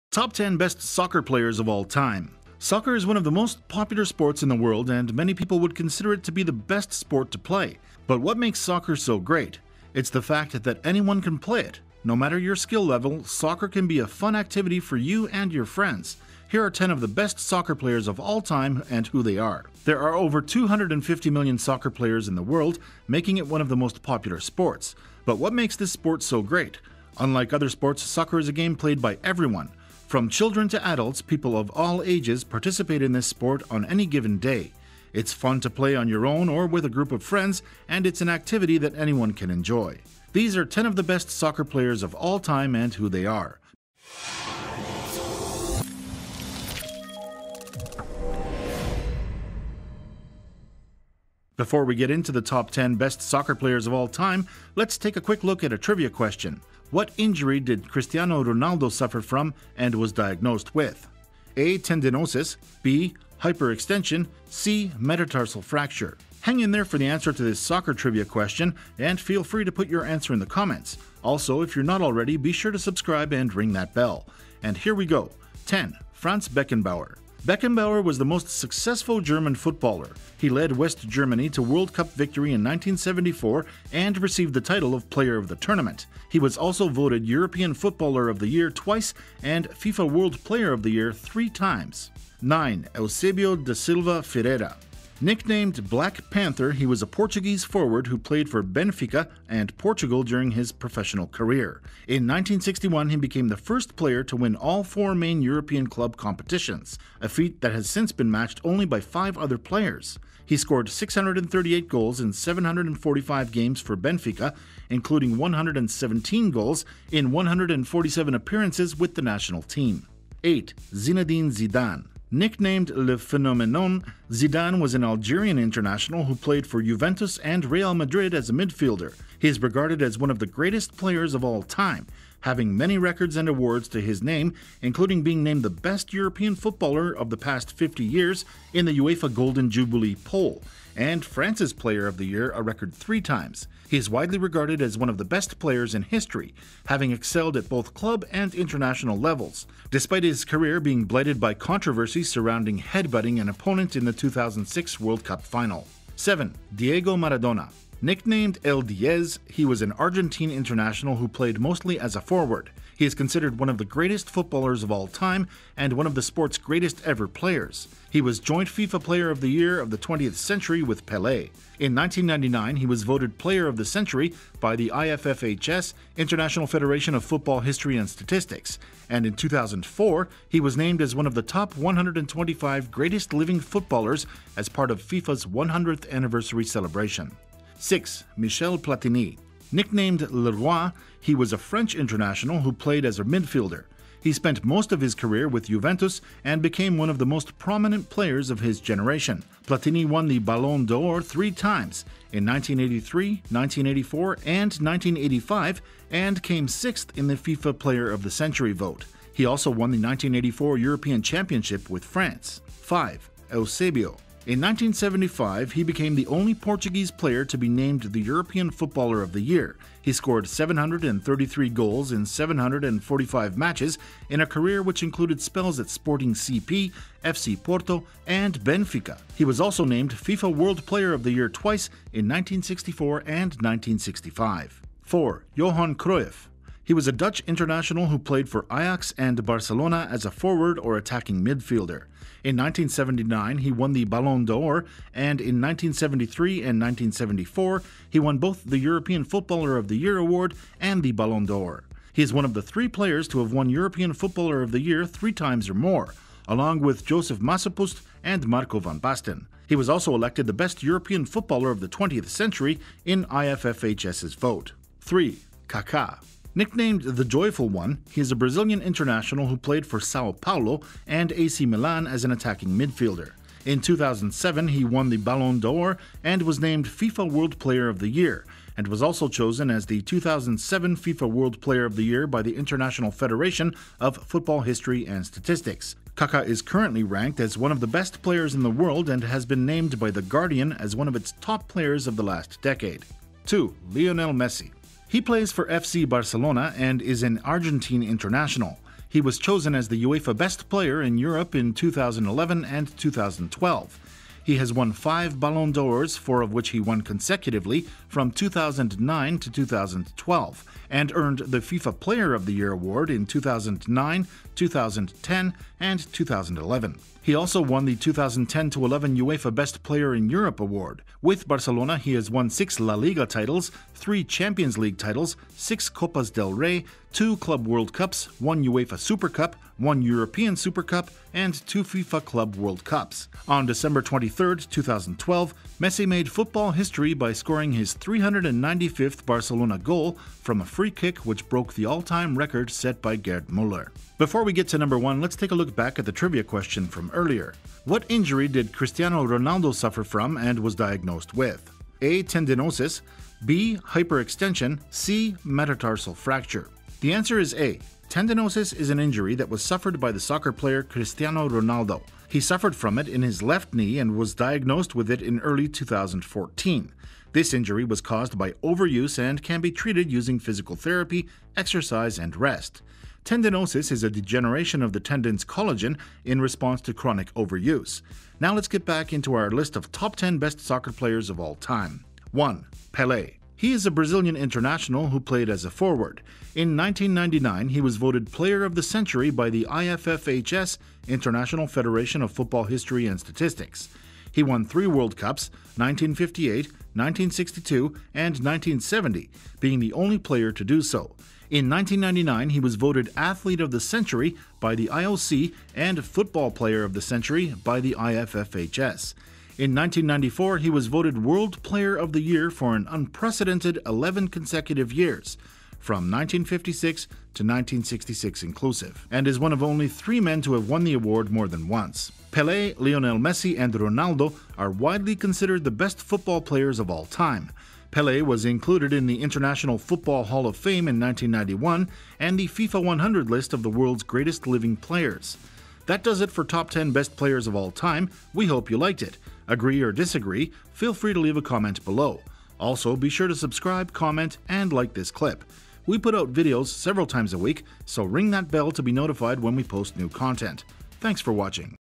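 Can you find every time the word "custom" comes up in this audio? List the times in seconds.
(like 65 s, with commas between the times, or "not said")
not said.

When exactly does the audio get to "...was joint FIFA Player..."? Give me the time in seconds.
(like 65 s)
168 s.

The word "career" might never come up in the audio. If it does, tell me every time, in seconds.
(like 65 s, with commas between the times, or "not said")
101 s, 150 s, 195 s, 224 s.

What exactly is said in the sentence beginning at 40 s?
These are 10 of the best soccer players of all time and who they are.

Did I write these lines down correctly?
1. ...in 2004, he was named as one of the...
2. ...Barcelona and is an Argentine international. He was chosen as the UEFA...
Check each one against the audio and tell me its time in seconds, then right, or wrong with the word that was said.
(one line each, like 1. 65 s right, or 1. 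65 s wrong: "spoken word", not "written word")
1. 179 s right
2. 296 s right.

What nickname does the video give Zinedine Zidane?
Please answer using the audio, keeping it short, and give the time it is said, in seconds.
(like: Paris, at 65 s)
Le Phenomenon, at 122 s.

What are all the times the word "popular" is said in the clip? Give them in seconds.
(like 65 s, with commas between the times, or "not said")
3 s, 24 s.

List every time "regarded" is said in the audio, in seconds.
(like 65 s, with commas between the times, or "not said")
129 s, 144 s.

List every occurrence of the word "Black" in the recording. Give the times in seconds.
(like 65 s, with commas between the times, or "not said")
95 s.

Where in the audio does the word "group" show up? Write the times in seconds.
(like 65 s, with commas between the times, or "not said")
36 s.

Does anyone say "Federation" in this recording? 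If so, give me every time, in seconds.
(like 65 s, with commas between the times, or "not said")
176 s, 283 s, 391 s.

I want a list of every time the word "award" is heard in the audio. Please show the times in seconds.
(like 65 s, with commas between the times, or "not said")
133 s, 250 s, 312 s, 320 s, 420 s.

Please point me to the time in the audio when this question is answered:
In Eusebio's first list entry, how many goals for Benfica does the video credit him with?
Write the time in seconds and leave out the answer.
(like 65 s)
110 s.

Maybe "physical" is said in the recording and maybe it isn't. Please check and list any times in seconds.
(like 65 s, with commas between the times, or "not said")
370 s.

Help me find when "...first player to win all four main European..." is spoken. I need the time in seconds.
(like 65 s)
103 s.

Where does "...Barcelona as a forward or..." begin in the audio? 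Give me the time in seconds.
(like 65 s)
239 s.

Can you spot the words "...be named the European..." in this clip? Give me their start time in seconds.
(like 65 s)
217 s.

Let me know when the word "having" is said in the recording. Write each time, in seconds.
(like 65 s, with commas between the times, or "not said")
132 s, 146 s.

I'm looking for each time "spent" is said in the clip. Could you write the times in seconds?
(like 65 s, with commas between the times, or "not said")
194 s.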